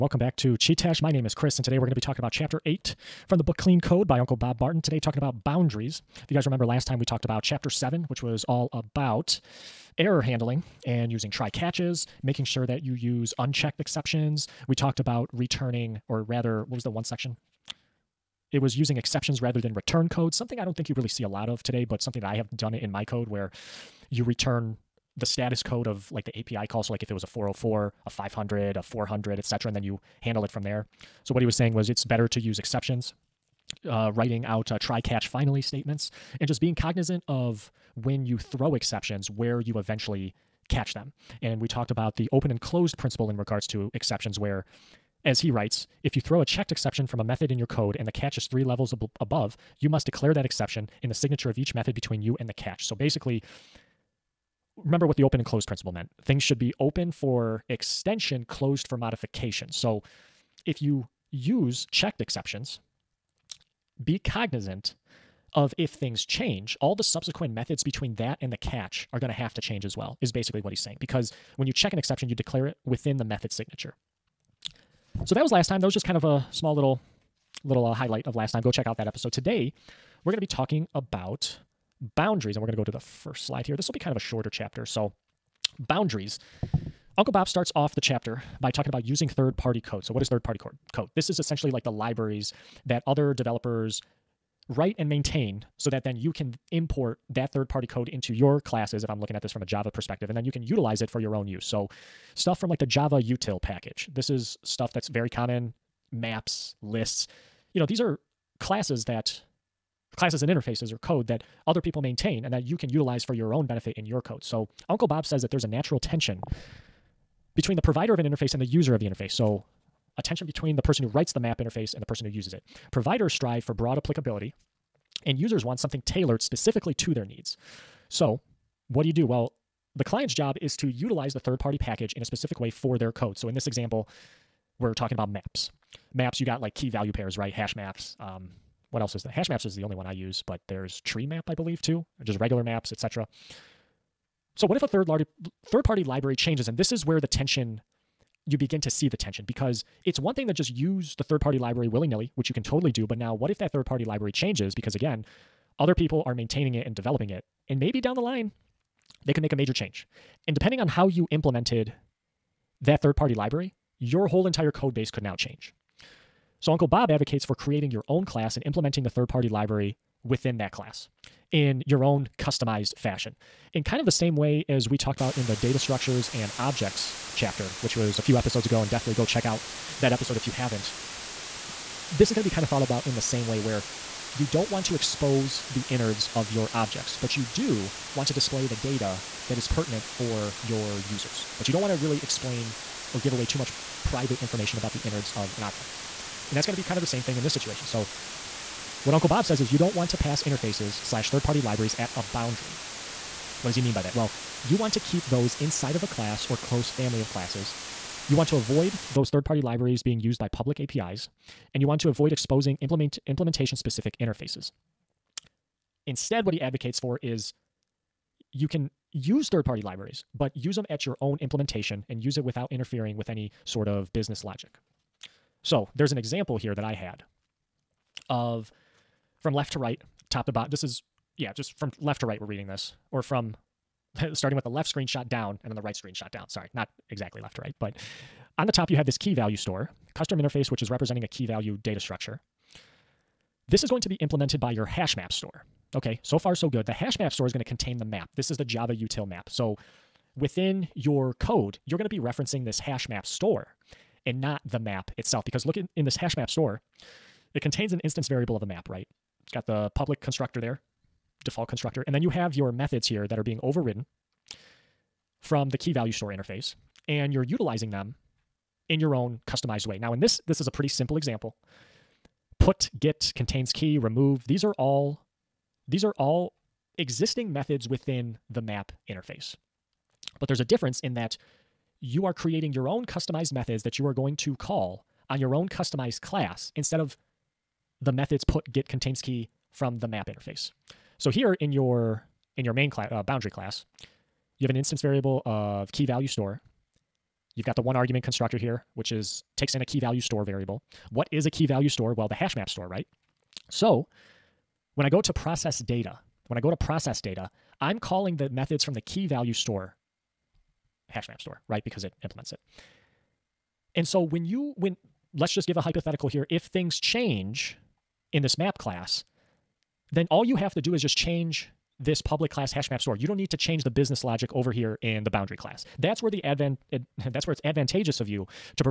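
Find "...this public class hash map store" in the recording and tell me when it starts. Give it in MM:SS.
05:21.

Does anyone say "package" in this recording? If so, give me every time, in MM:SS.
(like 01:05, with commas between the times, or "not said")
01:43, 02:11.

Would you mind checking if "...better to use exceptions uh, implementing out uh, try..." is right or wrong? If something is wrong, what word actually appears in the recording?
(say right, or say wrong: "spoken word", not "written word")
wrong: "writing", not "implementing".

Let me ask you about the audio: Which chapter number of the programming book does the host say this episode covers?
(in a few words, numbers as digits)
8.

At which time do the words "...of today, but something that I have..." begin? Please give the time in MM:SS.
00:21.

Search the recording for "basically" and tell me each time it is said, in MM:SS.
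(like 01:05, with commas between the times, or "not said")
00:52, 01:10.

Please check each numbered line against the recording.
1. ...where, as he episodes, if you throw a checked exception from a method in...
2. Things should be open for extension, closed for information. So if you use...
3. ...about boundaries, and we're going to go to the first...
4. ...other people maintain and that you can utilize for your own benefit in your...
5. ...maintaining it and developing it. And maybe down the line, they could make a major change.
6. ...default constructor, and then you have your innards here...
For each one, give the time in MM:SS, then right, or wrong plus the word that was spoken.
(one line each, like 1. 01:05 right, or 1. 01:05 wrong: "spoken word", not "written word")
1. 00:44 wrong: "writes", not "episodes"
2. 00:56 wrong: "modification", not "information"
3. 01:20 right
4. 01:51 right
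5. 02:36 right
6. 04:21 wrong: "methods", not "innards".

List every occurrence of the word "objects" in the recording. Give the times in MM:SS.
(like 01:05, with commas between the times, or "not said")
02:56, 03:06, 03:15.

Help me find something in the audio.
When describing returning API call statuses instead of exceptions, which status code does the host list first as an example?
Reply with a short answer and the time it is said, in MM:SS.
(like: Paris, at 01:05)
404, at 00:27.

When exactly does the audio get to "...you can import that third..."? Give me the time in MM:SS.
01:36.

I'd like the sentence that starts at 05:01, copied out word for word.
What is a key value store?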